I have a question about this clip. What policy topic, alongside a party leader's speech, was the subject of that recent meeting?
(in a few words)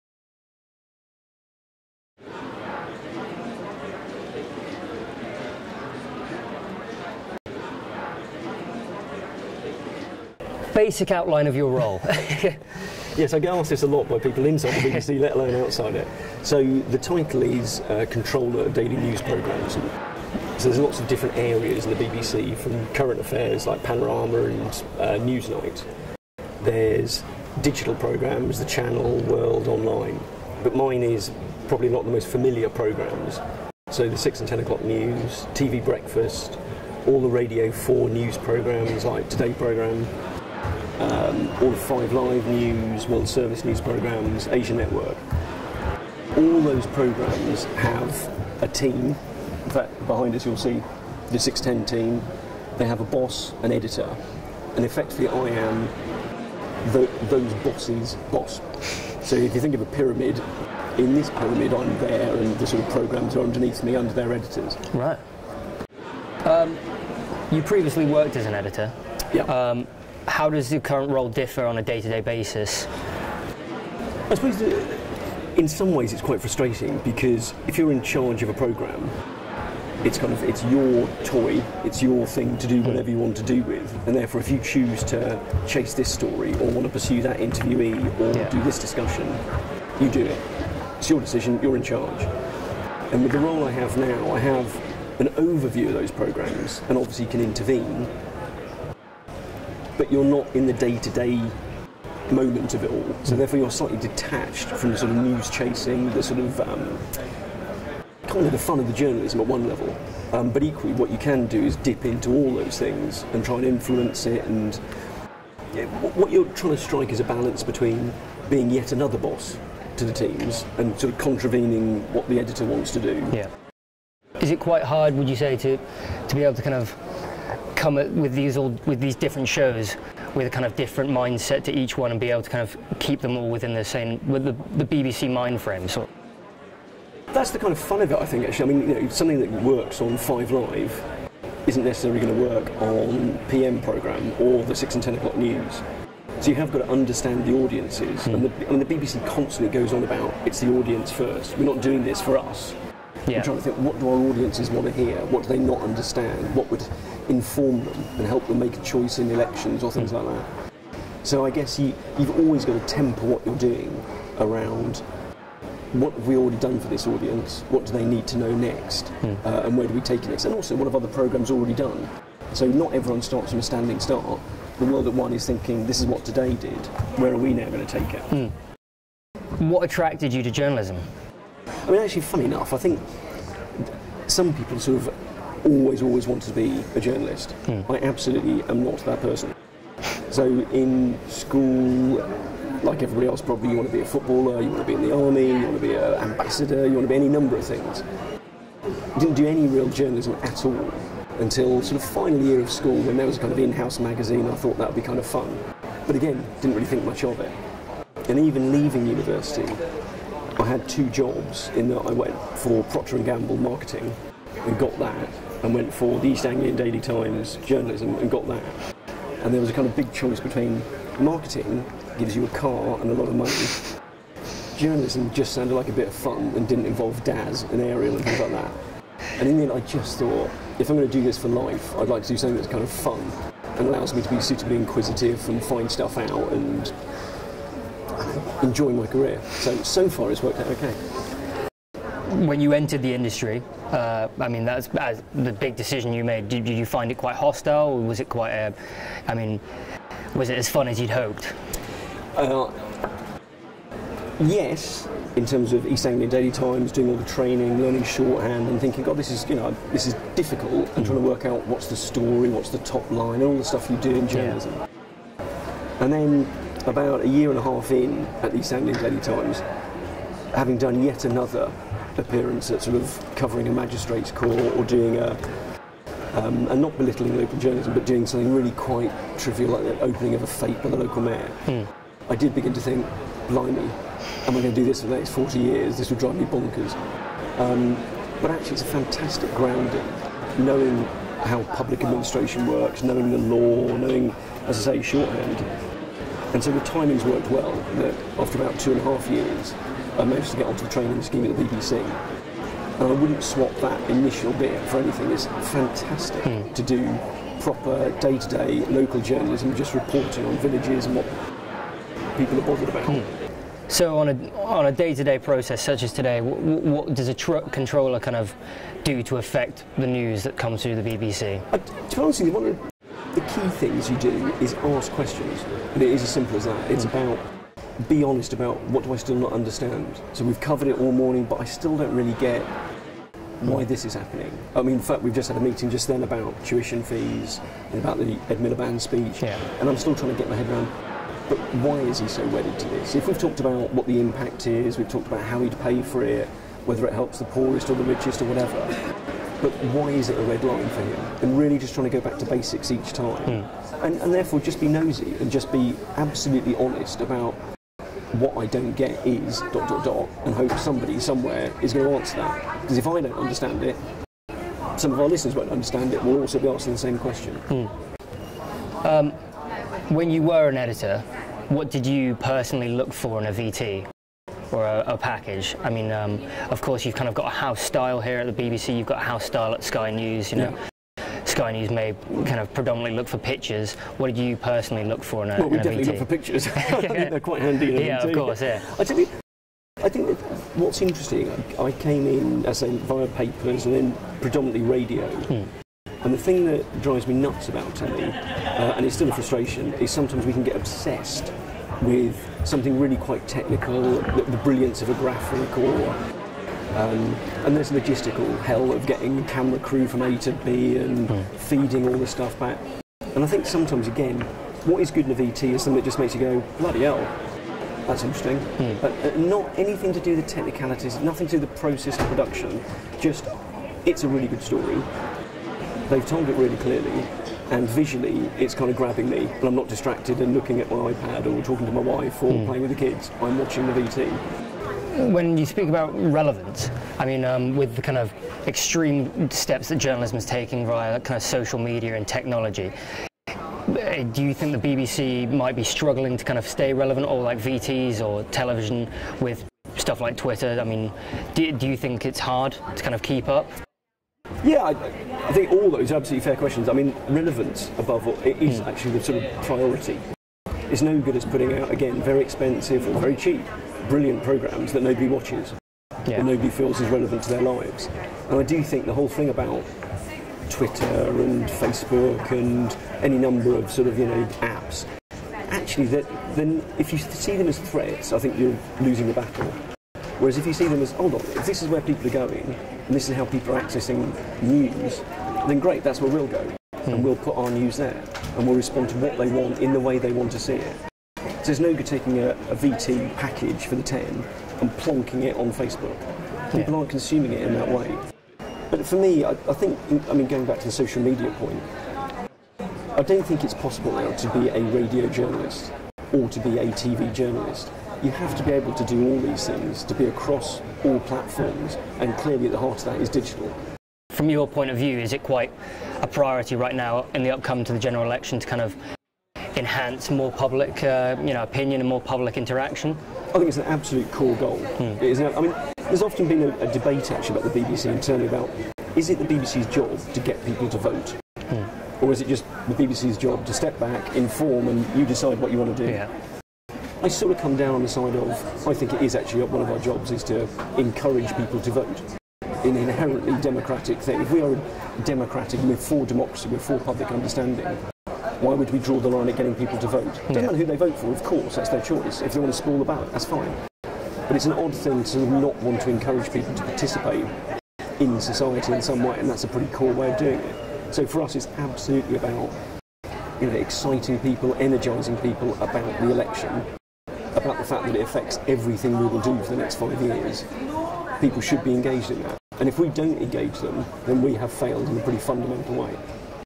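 Tuition fees.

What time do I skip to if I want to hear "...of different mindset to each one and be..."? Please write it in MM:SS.
02:10.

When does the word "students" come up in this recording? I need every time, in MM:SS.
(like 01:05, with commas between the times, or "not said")
not said.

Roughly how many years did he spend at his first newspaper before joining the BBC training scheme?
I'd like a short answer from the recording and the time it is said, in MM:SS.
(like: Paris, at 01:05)
2 and a half years, at 04:58.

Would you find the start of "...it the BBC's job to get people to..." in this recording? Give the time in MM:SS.
08:49.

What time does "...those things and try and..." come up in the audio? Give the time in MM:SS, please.
01:52.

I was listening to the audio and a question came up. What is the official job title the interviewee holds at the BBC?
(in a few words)
Controller of Daily News Programmes.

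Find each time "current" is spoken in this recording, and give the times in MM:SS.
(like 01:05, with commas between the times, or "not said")
00:22, 01:10.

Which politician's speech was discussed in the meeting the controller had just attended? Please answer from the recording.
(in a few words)
Ed Miliband.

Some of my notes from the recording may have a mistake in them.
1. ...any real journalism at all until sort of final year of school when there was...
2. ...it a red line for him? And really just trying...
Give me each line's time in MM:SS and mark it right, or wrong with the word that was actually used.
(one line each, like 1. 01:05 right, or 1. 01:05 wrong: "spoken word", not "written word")
1. 03:19 right
2. 05:50 right.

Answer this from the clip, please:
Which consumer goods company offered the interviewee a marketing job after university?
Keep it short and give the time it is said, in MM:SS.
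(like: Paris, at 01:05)
Procter and Gamble, at 03:32.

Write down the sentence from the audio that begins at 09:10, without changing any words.
It doesn't matter who they vote for, of course, that's their choice.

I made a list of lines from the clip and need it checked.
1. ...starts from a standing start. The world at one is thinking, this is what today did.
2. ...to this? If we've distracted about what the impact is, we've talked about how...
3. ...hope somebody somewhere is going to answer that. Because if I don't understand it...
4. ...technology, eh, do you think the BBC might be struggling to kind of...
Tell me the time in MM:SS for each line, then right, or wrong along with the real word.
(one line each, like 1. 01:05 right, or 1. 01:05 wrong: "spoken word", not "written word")
1. 02:53 right
2. 05:42 wrong: "talked", not "distracted"
3. 06:00 right
4. 07:22 right.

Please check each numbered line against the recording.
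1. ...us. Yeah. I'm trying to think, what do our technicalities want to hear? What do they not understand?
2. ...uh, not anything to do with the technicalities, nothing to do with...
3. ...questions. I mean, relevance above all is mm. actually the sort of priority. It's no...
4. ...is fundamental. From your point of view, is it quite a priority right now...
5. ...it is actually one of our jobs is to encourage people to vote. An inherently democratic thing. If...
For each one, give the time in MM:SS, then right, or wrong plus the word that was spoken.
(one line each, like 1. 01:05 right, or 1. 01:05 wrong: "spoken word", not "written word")
1. 02:32 wrong: "audiences", not "technicalities"
2. 06:59 right
3. 07:36 right
4. 08:33 wrong: "digital", not "fundamental"
5. 08:59 right.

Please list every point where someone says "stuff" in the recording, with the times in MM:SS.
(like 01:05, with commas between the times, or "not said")
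03:55, 04:23, 06:52, 07:29.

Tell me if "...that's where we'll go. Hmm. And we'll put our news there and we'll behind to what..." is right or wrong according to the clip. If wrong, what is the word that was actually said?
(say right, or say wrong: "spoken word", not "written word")
wrong: "respond", not "behind".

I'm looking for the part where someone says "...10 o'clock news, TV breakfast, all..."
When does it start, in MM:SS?
00:34.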